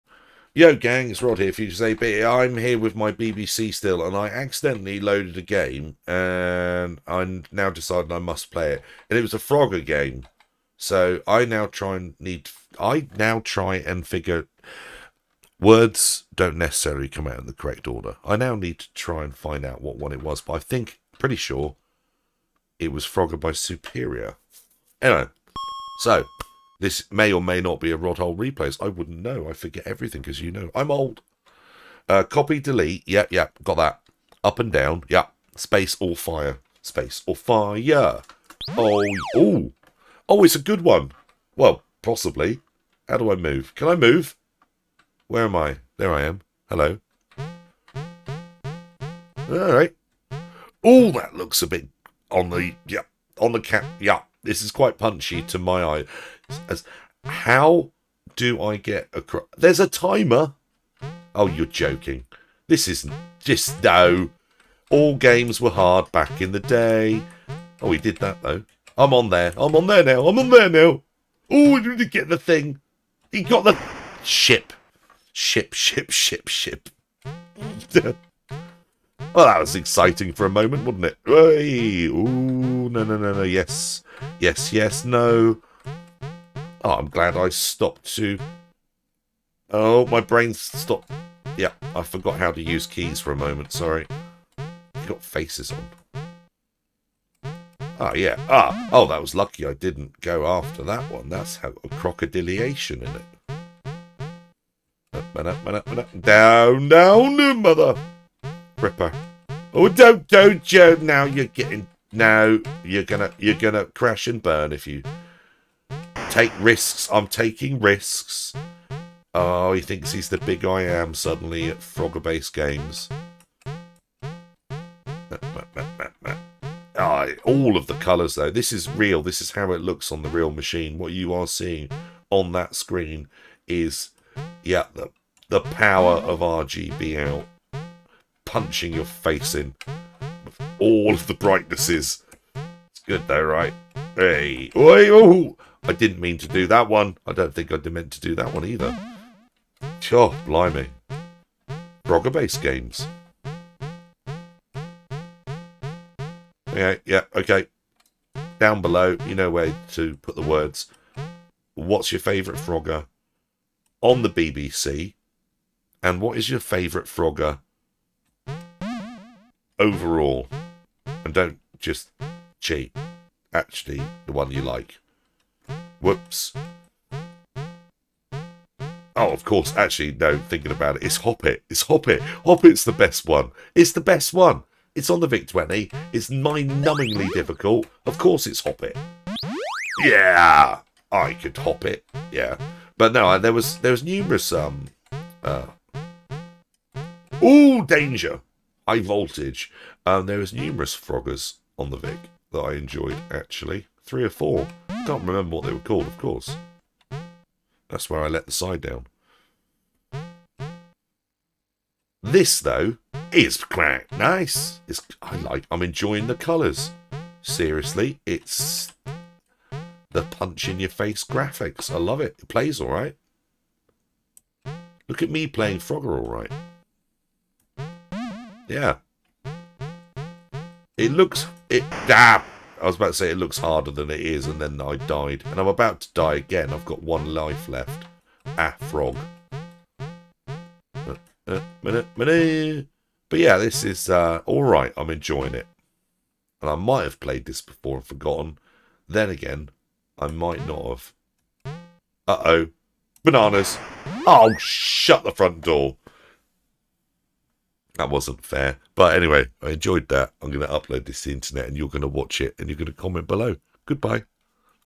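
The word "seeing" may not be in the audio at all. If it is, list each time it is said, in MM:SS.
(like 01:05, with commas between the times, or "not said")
02:11.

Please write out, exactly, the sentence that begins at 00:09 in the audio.
And it was a Frogger game, so I now try and need.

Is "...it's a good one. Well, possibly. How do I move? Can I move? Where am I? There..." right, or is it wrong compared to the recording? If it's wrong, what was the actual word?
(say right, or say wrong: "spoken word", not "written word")
right.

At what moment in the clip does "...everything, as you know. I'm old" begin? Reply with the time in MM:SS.
00:29.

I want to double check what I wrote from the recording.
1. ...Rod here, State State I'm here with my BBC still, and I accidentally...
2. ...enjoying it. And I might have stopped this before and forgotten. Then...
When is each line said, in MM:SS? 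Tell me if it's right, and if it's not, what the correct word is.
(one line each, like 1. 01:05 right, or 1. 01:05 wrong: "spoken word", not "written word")
1. 00:01 wrong: "Future", not "State"
2. 04:05 wrong: "played", not "stopped".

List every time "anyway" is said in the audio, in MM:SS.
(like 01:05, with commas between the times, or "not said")
00:25, 04:19.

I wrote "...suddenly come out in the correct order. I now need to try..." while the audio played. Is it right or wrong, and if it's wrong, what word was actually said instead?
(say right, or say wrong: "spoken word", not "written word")
wrong: "necessarily", not "suddenly".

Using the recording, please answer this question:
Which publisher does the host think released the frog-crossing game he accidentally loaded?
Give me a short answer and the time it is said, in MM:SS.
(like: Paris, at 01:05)
Superior, at 00:23.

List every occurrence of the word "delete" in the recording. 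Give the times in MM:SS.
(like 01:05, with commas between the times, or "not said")
00:32.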